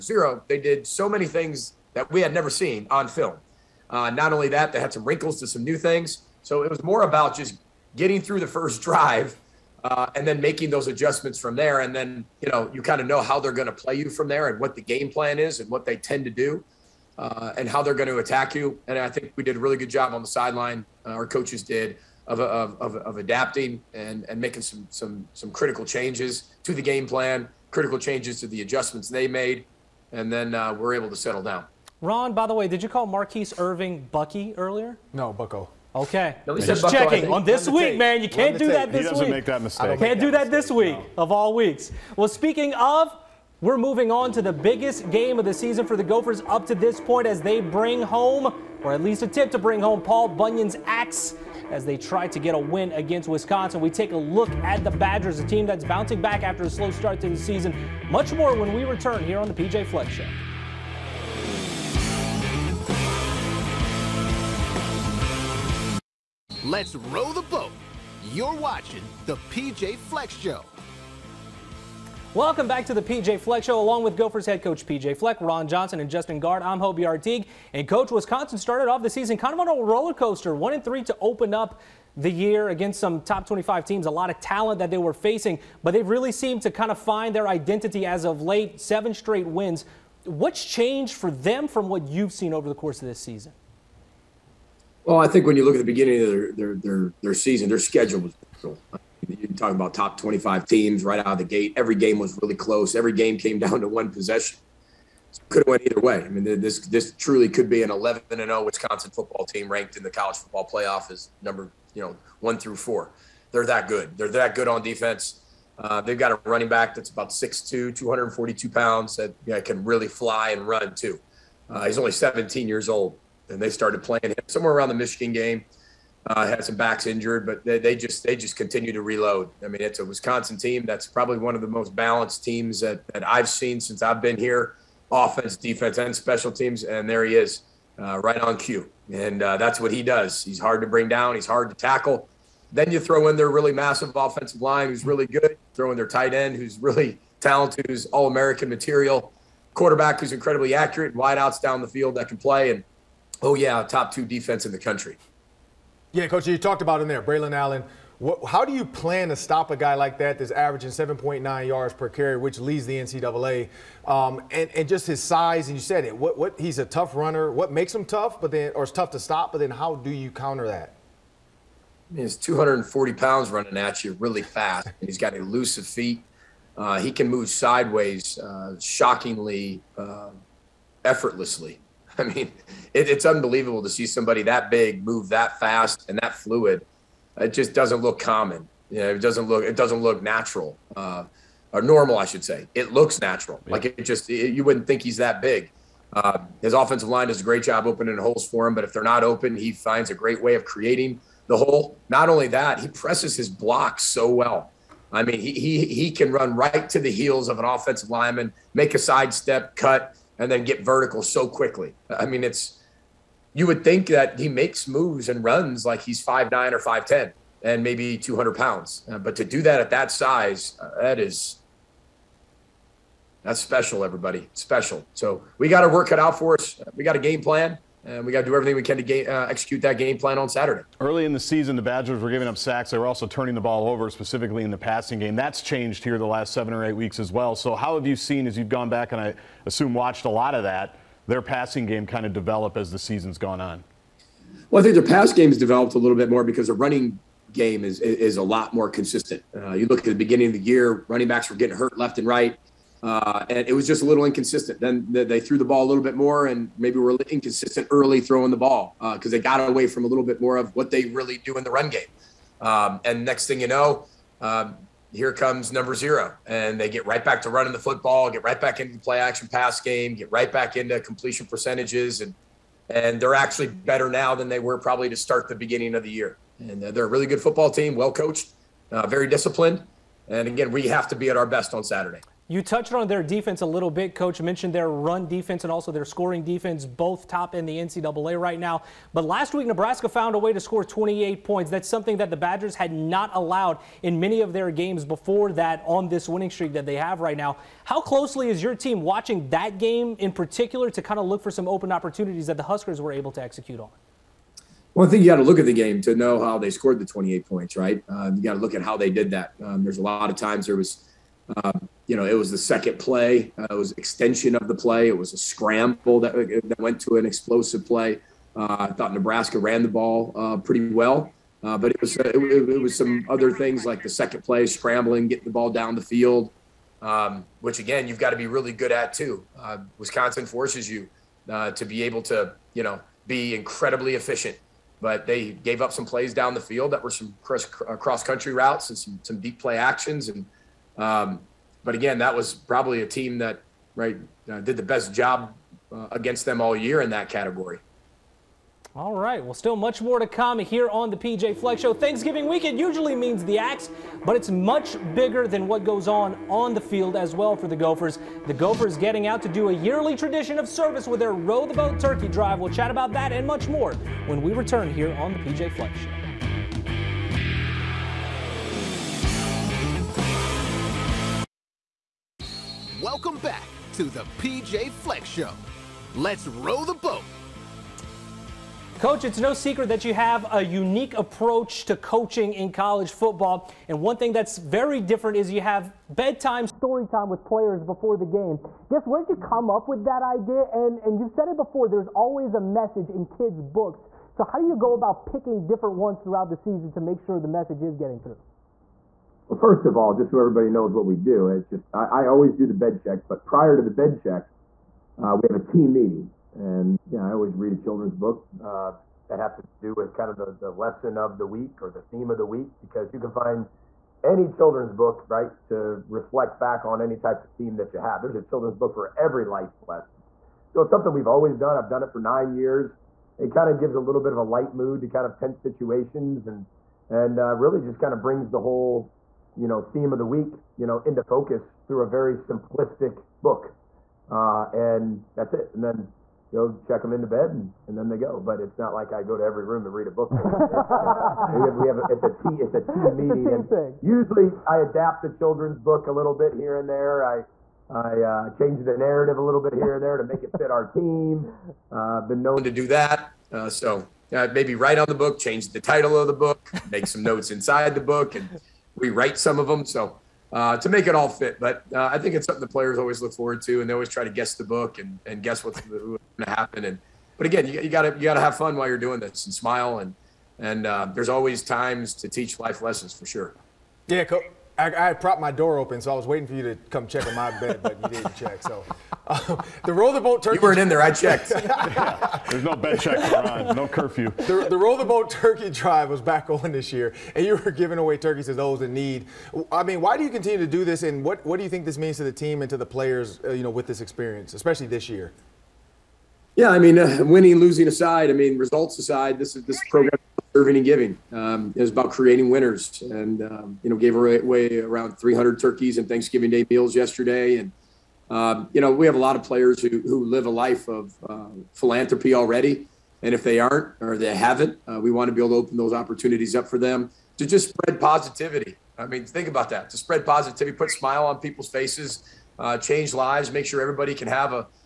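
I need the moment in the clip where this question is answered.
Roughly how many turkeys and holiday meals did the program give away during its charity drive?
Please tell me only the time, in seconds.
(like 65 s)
505 s.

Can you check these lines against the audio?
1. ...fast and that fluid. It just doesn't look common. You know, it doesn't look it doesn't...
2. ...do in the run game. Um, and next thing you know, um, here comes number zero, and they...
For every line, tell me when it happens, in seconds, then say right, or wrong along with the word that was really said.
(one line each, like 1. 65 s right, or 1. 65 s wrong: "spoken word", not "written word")
1. 185 s right
2. 261 s right.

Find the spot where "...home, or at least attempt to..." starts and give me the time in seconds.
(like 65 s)
48 s.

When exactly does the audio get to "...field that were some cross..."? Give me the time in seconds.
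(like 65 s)
336 s.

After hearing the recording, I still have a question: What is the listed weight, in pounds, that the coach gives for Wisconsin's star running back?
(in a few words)
242.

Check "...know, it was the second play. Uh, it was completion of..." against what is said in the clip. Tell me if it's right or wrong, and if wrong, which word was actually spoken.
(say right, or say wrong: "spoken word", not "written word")
wrong: "extension", not "completion".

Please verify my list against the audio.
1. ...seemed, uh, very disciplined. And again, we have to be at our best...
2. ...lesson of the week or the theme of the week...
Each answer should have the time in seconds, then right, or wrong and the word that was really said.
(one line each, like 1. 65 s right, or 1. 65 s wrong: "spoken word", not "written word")
1. 278 s wrong: "coached", not "seemed"
2. 410 s right.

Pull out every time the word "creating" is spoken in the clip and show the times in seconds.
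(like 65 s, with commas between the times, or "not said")
200 s, 502 s.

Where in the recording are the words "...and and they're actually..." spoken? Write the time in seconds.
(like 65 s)
272 s.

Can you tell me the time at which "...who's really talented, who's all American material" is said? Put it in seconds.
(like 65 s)
146 s.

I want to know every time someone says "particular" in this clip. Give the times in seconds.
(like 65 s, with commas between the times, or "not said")
300 s.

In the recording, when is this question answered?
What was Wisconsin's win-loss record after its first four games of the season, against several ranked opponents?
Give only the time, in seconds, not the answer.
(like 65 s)
80 s.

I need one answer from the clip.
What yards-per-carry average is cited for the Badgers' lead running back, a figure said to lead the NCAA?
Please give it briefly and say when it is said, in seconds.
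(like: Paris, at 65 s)
7.9, at 160 s.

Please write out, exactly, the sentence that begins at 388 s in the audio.
Guess where'd you come up with that idea?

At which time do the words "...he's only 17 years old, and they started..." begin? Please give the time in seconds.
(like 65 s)
121 s.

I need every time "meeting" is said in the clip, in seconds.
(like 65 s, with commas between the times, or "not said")
405 s, 443 s.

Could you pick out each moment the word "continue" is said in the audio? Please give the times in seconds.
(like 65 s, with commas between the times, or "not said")
128 s, 490 s.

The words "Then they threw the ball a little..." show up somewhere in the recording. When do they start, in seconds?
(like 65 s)
254 s.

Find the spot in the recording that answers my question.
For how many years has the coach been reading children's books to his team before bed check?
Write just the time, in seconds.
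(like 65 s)
422 s.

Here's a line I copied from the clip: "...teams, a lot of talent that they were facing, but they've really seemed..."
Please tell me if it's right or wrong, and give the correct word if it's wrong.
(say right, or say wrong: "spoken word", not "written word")
right.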